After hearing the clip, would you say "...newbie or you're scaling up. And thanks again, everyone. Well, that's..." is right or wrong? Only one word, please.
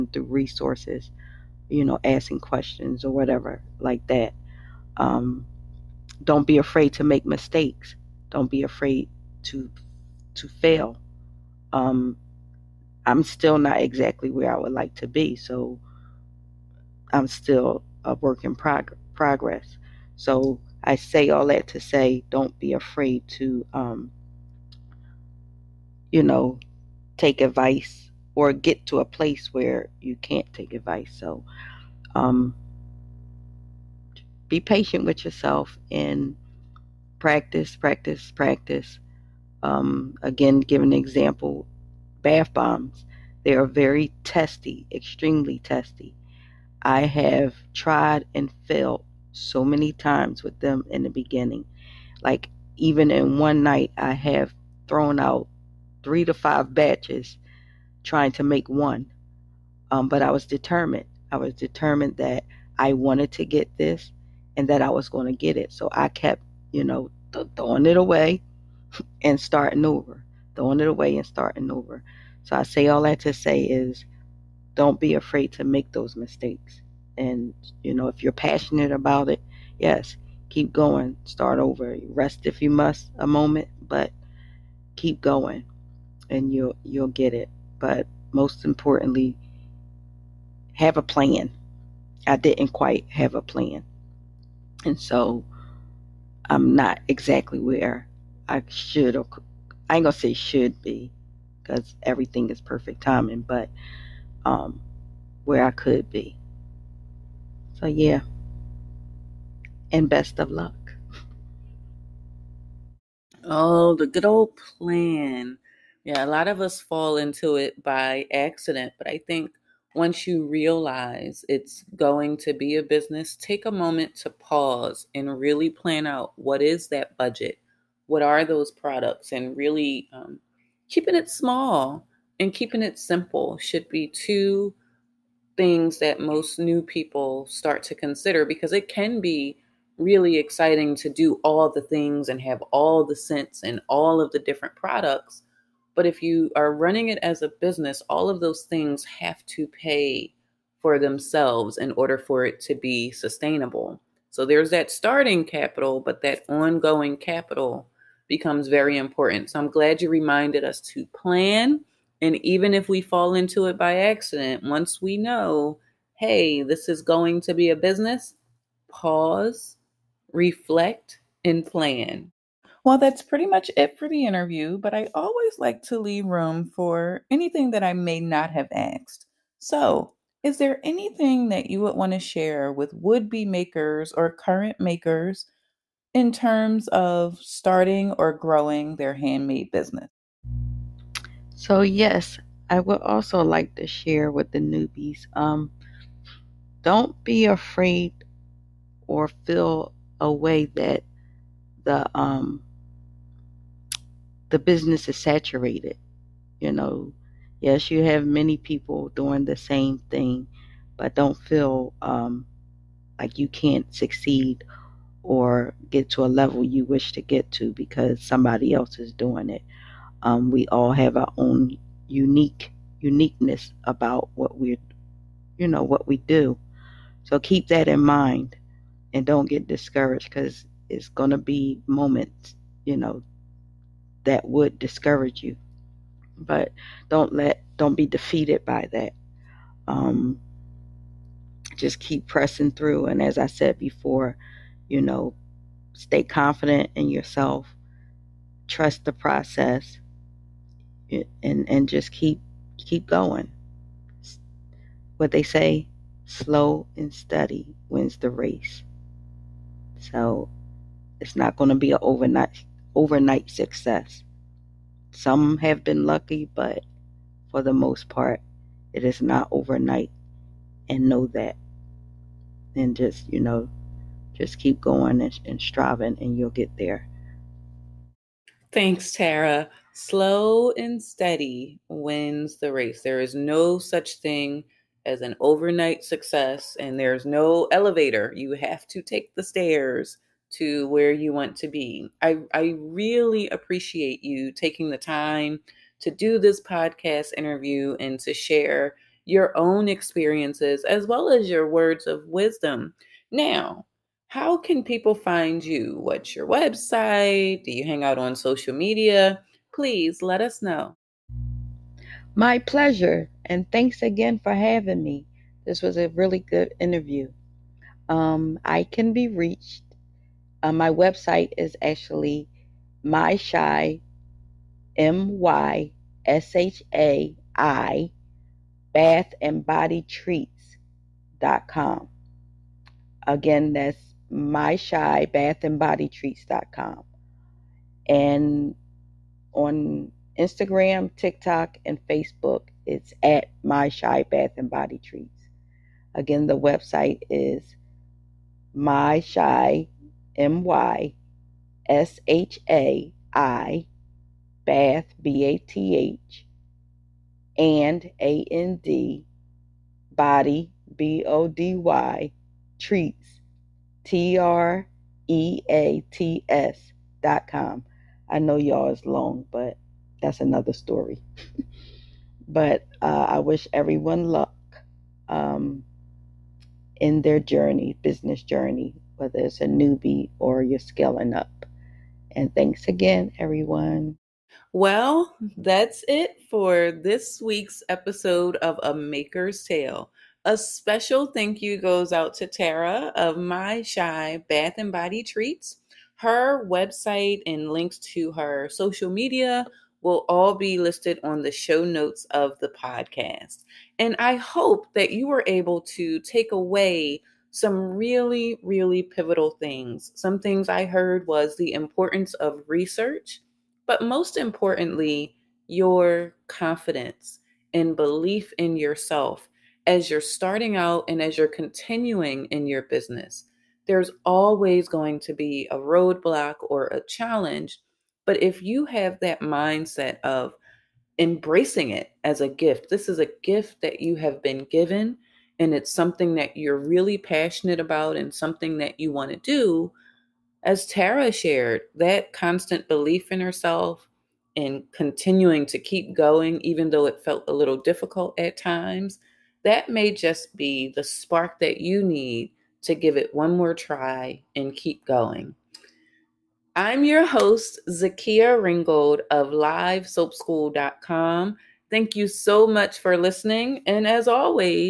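right.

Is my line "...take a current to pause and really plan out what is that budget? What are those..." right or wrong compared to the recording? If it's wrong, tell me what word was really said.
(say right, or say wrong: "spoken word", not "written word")
wrong: "moment", not "current".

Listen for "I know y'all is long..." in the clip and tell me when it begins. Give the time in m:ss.
6:08.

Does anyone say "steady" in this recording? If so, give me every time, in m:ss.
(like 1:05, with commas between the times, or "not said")
4:17, 4:41.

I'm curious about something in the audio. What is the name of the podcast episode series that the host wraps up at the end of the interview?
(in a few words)
A Maker's Tale.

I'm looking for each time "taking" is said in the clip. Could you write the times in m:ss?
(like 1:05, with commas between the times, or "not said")
4:54.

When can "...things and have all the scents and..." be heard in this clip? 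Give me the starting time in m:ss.
2:21.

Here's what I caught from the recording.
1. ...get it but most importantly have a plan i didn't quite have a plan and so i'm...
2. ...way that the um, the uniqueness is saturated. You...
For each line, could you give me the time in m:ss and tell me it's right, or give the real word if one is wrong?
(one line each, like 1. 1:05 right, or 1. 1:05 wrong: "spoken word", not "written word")
1. 1:27 right
2. 3:20 wrong: "business", not "uniqueness".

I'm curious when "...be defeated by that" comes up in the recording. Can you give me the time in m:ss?
3:57.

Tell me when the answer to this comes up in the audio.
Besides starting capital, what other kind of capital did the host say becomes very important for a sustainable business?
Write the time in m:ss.
2:36.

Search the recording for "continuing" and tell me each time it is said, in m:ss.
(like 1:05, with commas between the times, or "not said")
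7:01, 7:24.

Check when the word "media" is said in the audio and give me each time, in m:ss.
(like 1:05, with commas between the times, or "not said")
5:08, 6:39.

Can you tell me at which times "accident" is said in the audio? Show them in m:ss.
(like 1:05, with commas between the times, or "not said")
1:58, 2:43.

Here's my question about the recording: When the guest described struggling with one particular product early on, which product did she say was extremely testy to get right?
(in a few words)
bath bombs.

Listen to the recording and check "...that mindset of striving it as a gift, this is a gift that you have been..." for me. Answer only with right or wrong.
wrong.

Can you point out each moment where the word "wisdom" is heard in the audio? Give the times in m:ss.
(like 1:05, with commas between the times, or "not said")
5:02.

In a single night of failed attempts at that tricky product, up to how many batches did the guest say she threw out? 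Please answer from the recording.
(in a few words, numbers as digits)
5.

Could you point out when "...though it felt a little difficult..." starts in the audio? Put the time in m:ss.
7:26.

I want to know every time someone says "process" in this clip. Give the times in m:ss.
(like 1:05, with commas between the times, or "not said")
4:09.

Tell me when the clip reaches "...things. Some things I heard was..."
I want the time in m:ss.
6:49.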